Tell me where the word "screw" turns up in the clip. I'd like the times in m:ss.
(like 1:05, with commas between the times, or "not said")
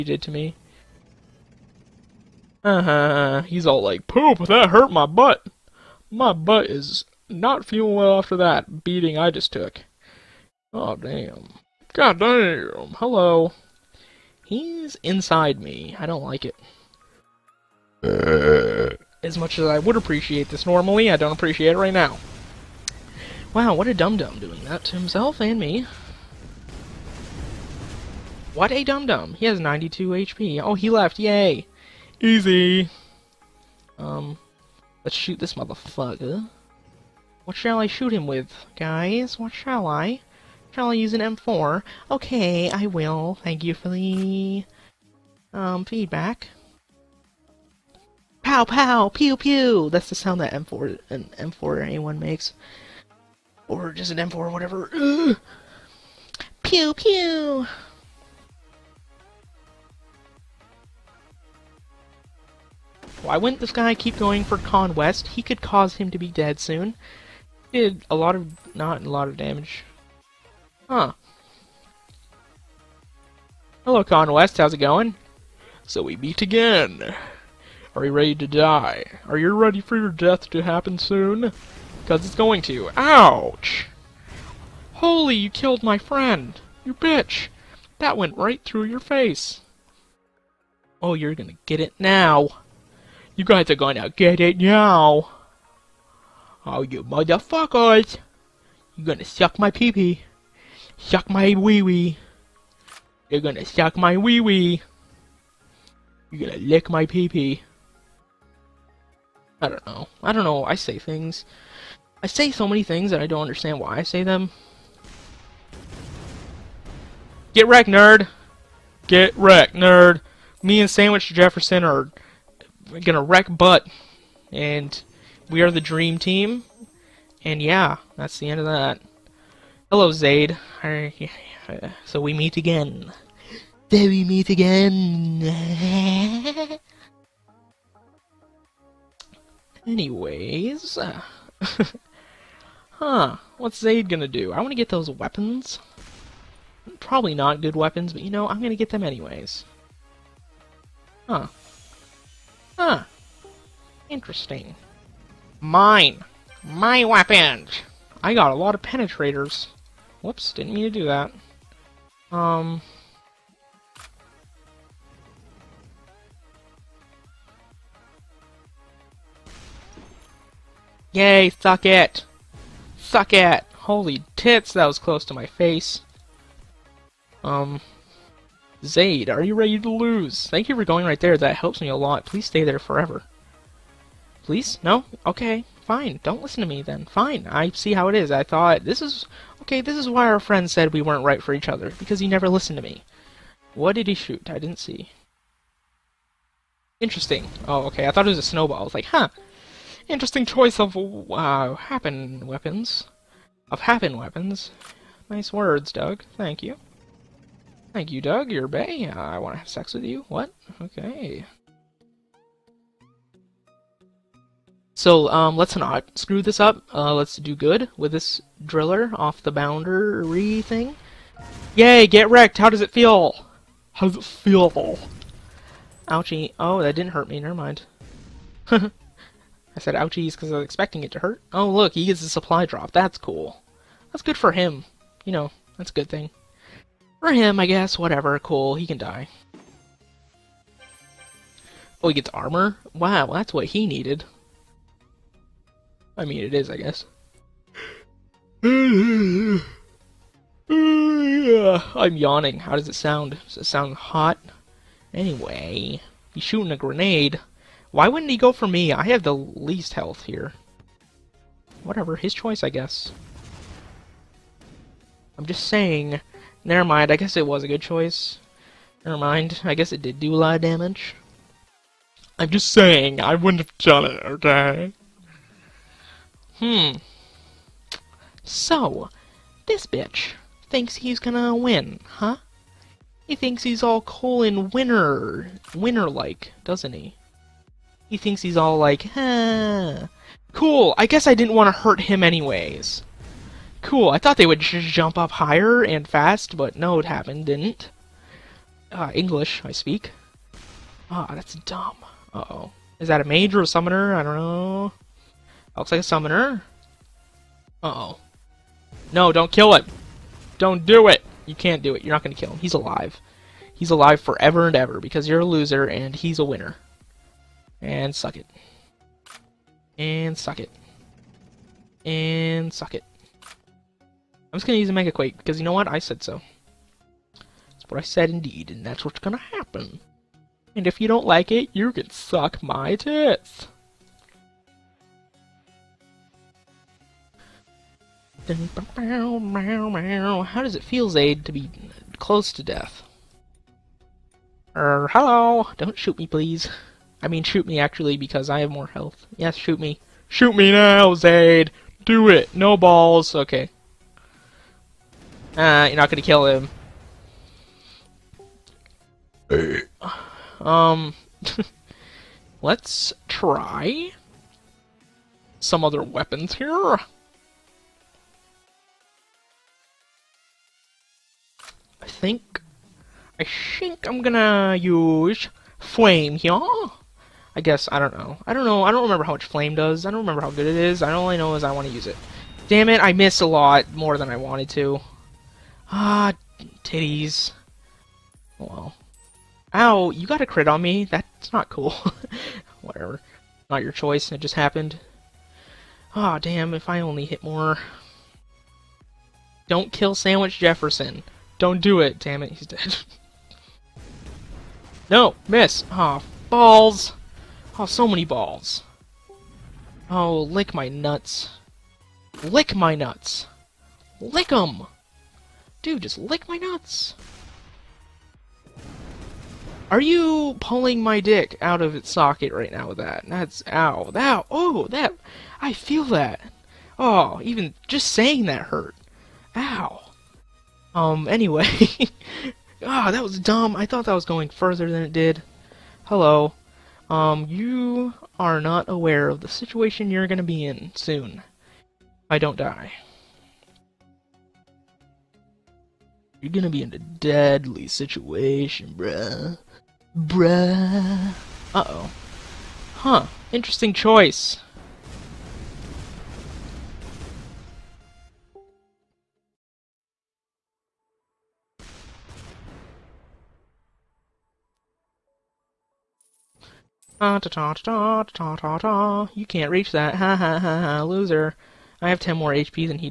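3:36.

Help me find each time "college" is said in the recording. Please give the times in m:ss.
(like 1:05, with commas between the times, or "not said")
not said.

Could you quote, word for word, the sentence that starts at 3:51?
Oh, look, he gets a supply drop.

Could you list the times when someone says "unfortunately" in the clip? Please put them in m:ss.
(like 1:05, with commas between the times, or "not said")
not said.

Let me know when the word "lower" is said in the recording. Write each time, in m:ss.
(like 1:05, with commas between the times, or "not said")
not said.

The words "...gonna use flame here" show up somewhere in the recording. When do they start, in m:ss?
6:14.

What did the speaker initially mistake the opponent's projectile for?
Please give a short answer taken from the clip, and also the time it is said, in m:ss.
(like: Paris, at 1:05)
A snowball, at 3:18.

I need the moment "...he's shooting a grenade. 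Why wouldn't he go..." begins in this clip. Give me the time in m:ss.
4:16.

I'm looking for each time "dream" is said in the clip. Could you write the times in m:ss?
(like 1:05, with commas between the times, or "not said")
2:05.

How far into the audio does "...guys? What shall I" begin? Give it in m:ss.
0:38.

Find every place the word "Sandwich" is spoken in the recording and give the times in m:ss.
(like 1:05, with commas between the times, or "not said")
2:00, 6:40.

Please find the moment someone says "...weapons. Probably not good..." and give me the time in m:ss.
2:25.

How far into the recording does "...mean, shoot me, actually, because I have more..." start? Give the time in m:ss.
5:47.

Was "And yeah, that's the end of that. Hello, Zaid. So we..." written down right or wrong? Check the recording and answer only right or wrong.
right.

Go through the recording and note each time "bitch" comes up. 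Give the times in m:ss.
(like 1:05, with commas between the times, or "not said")
1:26, 4:39.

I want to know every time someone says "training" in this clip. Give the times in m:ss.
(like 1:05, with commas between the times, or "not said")
not said.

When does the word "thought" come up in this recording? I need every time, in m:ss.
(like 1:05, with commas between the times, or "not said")
3:08, 3:18, 4:54, 7:13.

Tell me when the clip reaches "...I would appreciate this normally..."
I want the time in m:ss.
0:19.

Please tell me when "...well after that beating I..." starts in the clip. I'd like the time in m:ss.
0:07.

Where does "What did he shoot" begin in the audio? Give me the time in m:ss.
3:13.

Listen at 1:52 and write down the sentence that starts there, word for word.
I say so many things that I don't understand why I say them.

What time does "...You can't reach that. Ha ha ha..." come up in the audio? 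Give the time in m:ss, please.
7:49.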